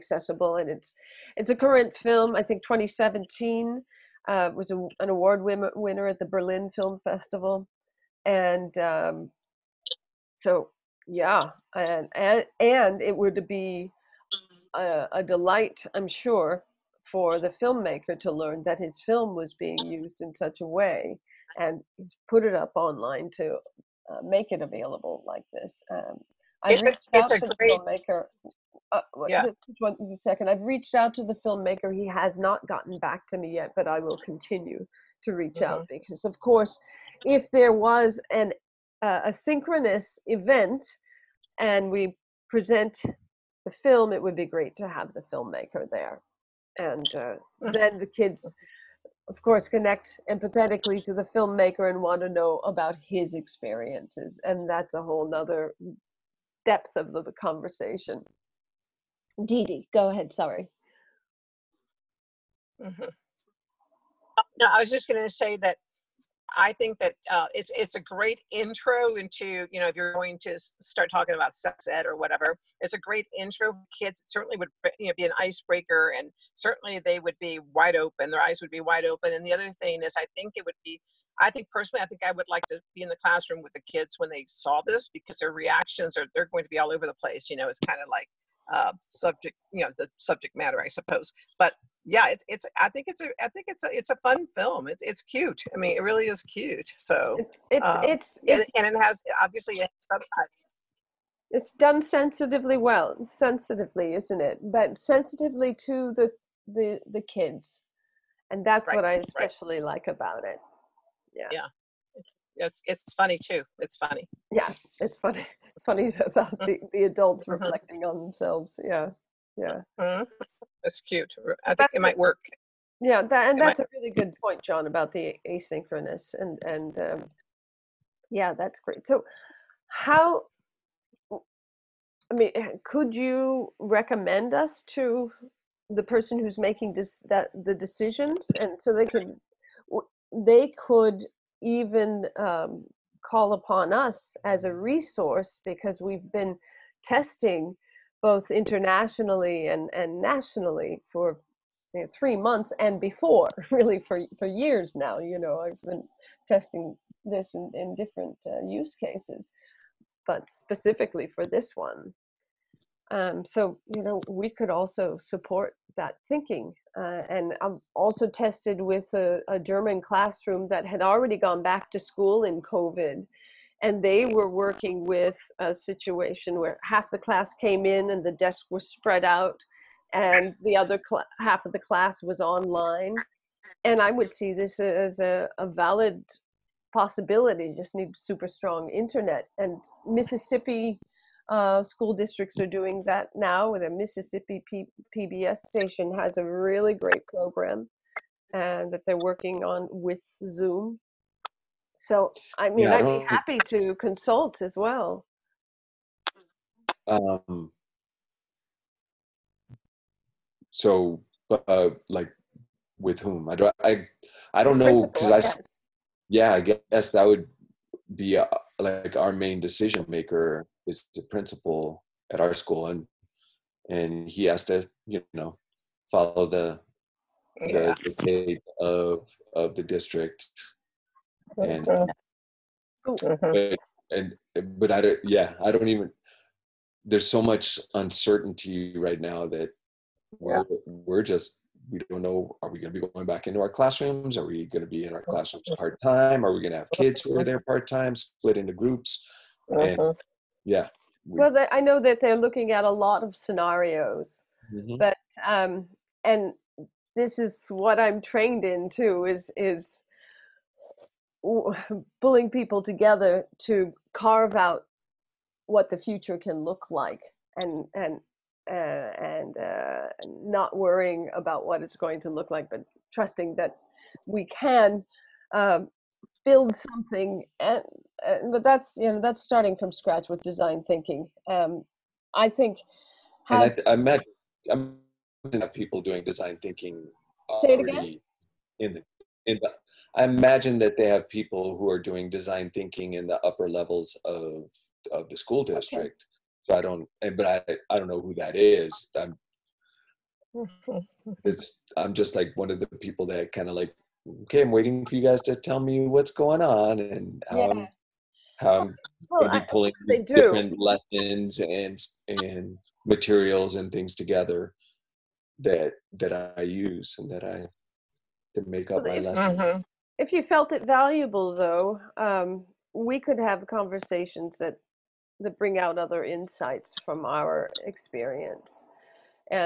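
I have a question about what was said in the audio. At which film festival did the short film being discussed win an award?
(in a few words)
Berlin Film Festival.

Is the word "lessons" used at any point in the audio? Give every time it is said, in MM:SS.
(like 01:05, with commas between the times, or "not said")
05:10, 05:19.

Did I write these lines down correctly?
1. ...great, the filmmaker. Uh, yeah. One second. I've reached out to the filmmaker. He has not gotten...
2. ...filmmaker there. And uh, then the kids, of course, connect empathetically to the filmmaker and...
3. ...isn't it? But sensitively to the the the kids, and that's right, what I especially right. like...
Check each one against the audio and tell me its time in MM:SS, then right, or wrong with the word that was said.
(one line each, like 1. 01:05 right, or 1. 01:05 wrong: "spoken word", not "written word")
1. 00:27 right
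2. 00:45 right
3. 01:44 right.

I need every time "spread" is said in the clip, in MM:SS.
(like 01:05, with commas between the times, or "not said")
02:58.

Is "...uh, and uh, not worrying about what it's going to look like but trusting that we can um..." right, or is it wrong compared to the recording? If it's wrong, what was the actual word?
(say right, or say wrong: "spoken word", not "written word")
right.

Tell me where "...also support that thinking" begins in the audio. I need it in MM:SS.
02:44.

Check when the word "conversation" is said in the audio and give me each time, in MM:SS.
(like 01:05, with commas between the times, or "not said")
00:57, 05:23.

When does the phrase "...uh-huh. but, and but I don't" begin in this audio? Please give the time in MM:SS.
03:51.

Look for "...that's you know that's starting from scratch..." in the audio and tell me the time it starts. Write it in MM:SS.
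04:38.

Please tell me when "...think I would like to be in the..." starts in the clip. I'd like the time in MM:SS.
01:22.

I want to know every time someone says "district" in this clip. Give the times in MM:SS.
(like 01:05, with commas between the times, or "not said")
03:12, 03:49, 04:55.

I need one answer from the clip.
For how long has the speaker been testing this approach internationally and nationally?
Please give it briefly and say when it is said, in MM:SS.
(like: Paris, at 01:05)
three months, at 02:32.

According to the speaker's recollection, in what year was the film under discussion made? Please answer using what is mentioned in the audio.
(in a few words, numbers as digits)
2017.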